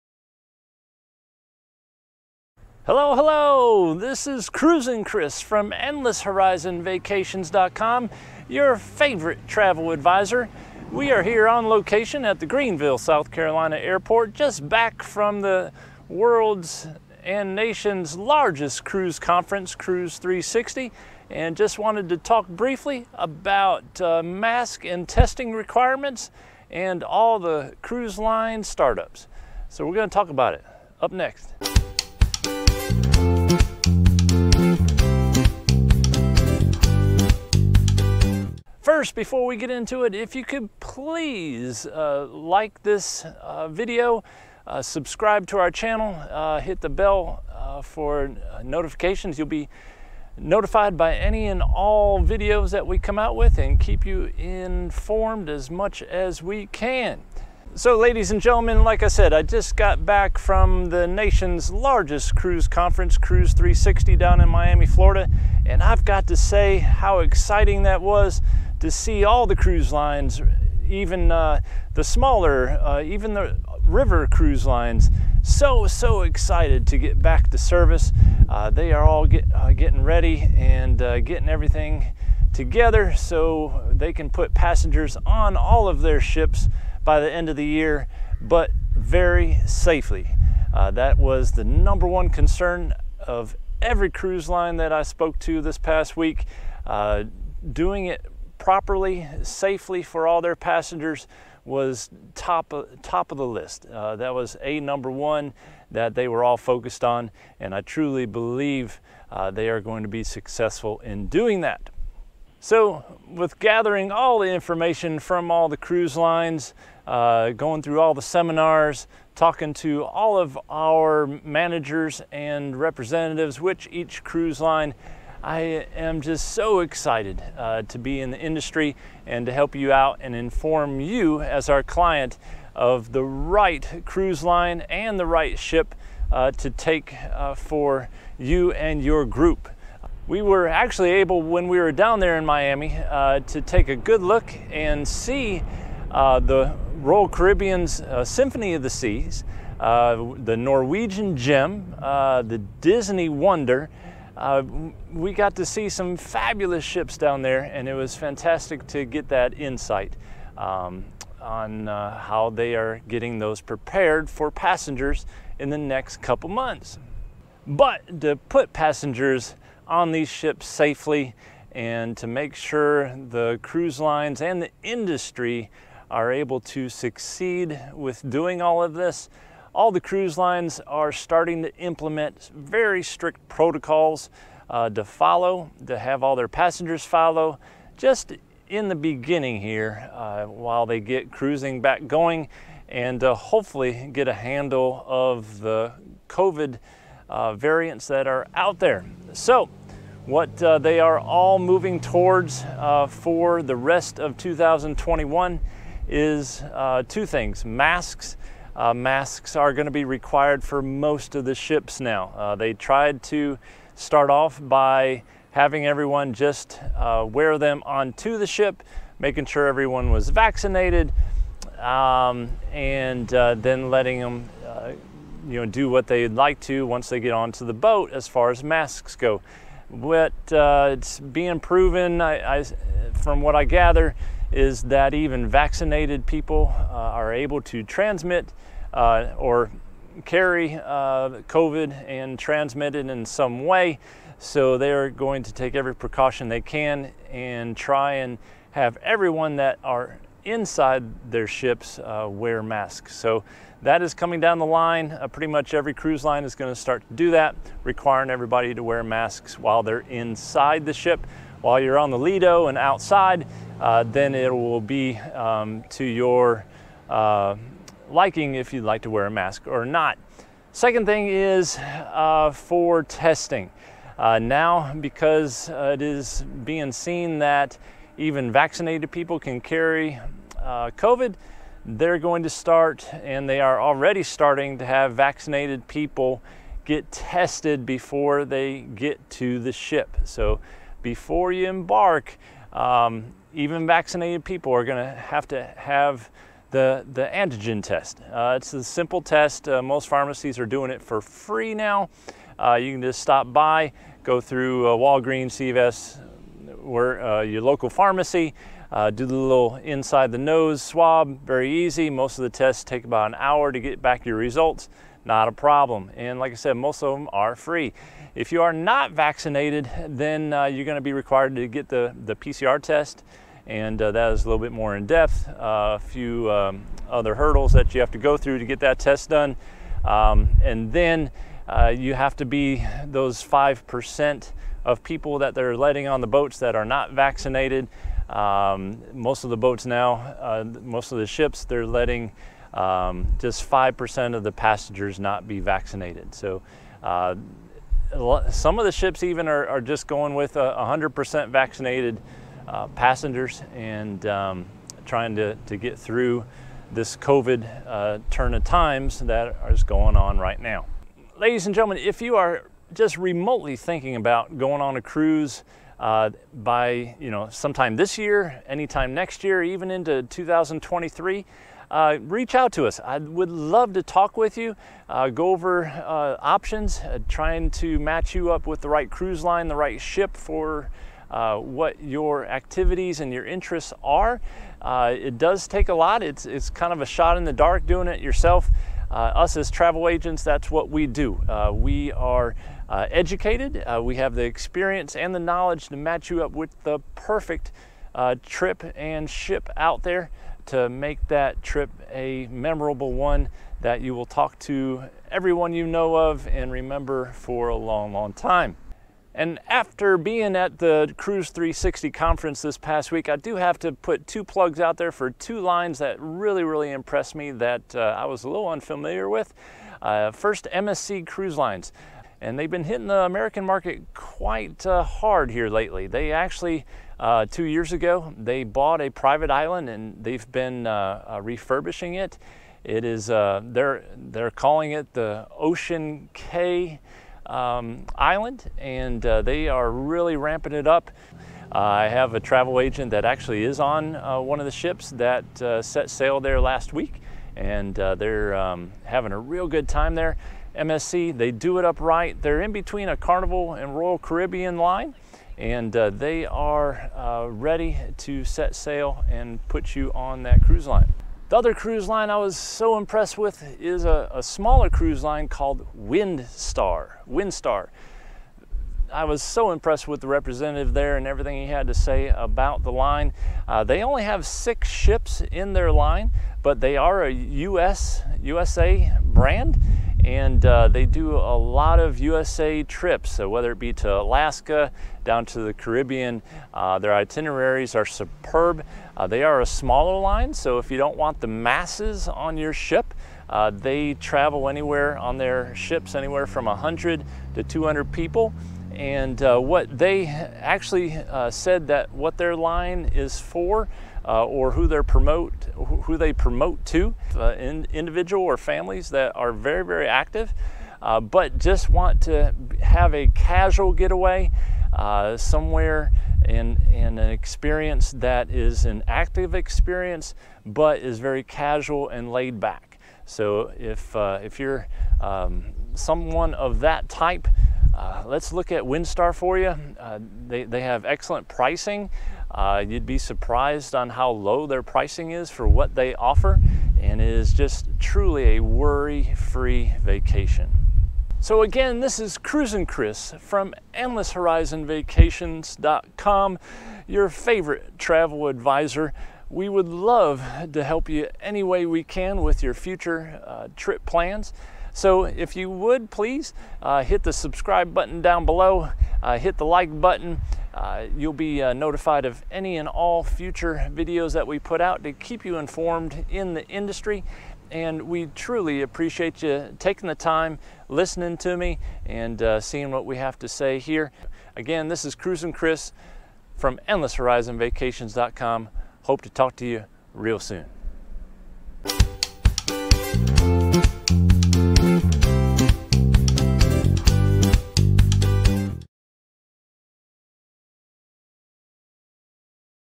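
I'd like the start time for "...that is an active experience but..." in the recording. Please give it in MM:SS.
08:38.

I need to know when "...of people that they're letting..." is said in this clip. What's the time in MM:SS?
05:34.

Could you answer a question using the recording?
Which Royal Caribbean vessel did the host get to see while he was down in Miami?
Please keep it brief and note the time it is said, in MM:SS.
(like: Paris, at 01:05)
Symphony of the Seas, at 02:28.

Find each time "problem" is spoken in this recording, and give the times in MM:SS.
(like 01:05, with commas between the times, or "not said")
05:15.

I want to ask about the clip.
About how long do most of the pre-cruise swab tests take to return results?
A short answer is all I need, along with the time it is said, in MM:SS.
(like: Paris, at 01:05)
about an hour, at 05:13.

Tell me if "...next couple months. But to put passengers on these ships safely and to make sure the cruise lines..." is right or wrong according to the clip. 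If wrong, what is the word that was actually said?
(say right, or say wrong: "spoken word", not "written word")
right.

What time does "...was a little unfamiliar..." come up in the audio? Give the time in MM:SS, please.
06:58.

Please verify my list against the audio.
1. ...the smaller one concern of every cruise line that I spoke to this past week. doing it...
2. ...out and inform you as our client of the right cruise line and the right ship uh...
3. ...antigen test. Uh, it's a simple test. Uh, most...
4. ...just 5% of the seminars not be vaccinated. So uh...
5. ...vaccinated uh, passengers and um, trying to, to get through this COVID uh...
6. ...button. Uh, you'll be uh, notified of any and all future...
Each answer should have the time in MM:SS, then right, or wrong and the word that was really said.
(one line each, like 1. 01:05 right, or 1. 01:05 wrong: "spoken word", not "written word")
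1. 01:31 wrong: "number", not "smaller"
2. 02:09 right
3. 04:57 right
4. 05:43 wrong: "passengers", not "seminars"
5. 05:51 right
6. 09:20 right.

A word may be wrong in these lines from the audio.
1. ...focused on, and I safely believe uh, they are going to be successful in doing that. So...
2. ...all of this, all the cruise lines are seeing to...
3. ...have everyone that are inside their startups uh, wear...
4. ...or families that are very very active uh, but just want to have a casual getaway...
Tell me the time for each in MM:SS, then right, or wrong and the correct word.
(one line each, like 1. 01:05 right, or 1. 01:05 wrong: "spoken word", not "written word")
1. 01:46 wrong: "truly", not "safely"
2. 02:58 wrong: "starting", not "seeing"
3. 04:08 wrong: "ships", not "startups"
4. 08:28 right.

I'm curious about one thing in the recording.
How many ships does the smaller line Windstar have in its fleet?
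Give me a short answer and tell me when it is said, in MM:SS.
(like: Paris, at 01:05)
6, at 07:54.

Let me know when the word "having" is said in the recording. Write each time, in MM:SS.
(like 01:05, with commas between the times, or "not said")
03:35, 07:29.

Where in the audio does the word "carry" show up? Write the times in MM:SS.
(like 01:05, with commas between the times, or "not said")
04:00, 04:39.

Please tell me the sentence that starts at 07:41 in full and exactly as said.
The other cruise line I was so impressed with is a, a smaller cruise line called Windstar.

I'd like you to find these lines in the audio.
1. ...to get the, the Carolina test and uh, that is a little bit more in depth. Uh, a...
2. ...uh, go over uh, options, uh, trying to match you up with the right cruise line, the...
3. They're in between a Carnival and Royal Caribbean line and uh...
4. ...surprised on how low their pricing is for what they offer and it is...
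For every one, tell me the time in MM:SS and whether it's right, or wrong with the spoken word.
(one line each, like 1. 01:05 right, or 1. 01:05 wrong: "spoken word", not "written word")
1. 05:21 wrong: "PCR", not "Carolina"
2. 06:15 right
3. 07:32 right
4. 08:53 right.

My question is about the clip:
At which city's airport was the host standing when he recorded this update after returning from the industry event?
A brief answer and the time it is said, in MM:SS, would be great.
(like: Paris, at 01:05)
Greenville, South Carolina, at 00:12.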